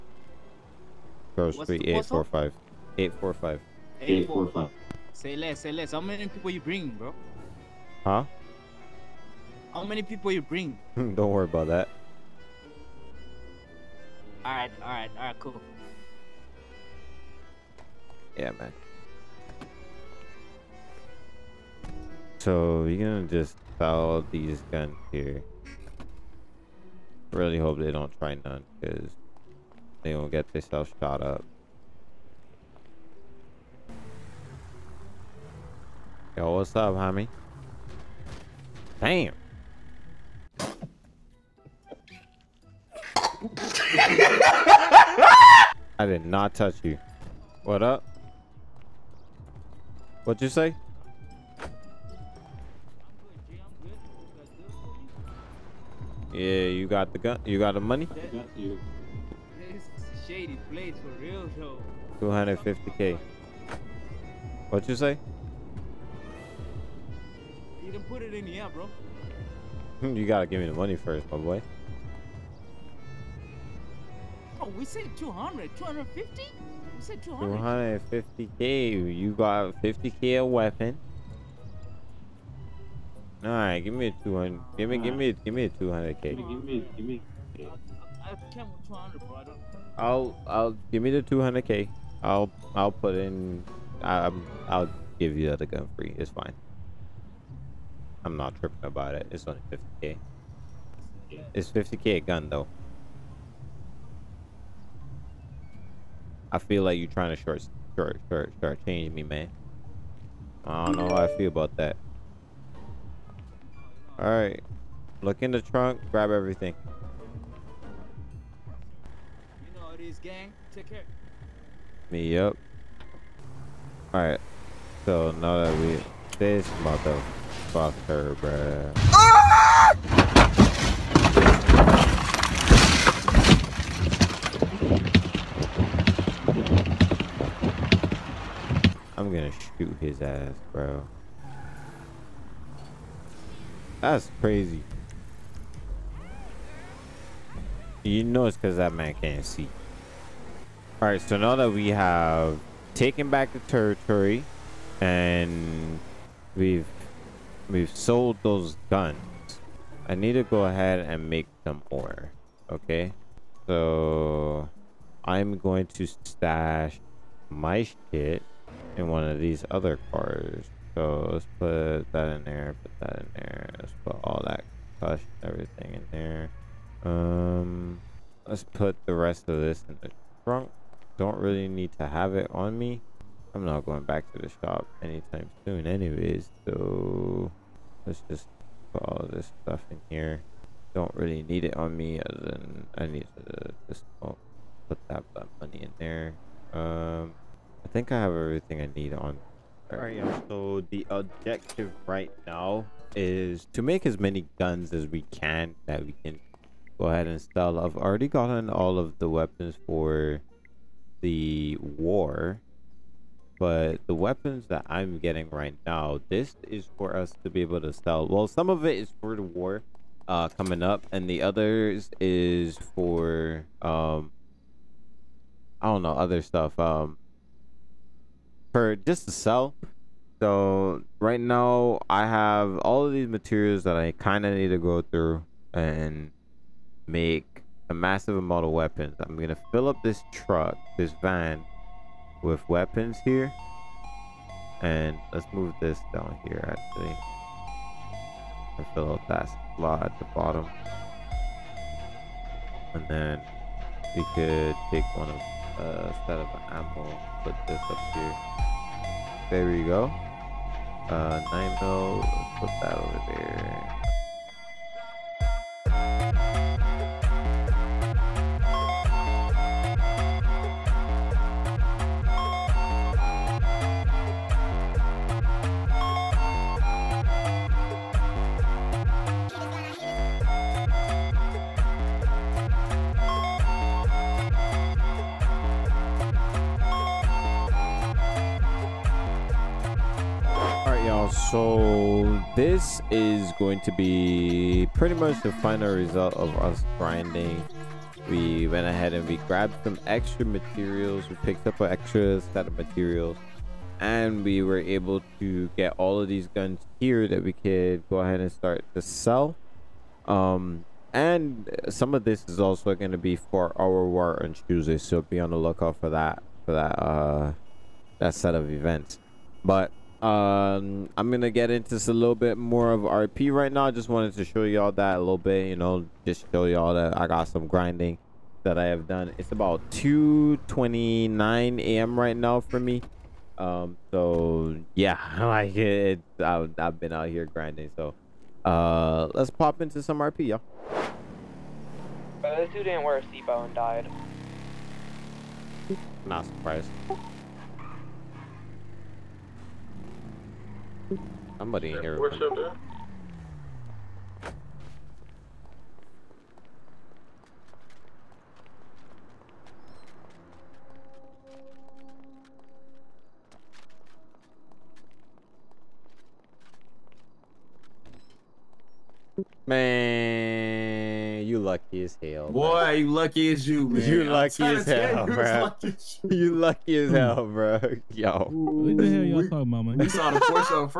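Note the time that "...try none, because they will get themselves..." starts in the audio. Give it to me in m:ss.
0:28.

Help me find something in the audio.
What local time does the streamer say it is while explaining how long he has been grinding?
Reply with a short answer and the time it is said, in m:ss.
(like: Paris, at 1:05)
2:29 a.m., at 5:29.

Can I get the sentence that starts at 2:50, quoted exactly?
So let's put that in there, put that in there.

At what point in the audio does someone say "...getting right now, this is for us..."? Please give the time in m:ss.
3:35.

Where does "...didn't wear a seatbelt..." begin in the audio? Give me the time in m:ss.
5:42.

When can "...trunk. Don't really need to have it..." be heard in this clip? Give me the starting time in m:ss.
3:00.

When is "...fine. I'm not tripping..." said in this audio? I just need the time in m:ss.
1:36.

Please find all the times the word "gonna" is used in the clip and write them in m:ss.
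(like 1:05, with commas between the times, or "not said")
0:23, 2:19, 5:21.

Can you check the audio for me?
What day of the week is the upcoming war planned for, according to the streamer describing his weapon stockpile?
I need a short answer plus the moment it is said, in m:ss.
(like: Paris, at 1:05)
Tuesday, at 5:14.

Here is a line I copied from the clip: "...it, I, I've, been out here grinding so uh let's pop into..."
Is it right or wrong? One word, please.
right.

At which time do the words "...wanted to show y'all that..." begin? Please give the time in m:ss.
5:24.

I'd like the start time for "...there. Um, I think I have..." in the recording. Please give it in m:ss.
3:15.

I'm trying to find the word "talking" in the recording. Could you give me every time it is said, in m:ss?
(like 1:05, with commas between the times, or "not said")
6:19.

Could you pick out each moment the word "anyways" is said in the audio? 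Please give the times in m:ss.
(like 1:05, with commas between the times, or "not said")
3:05.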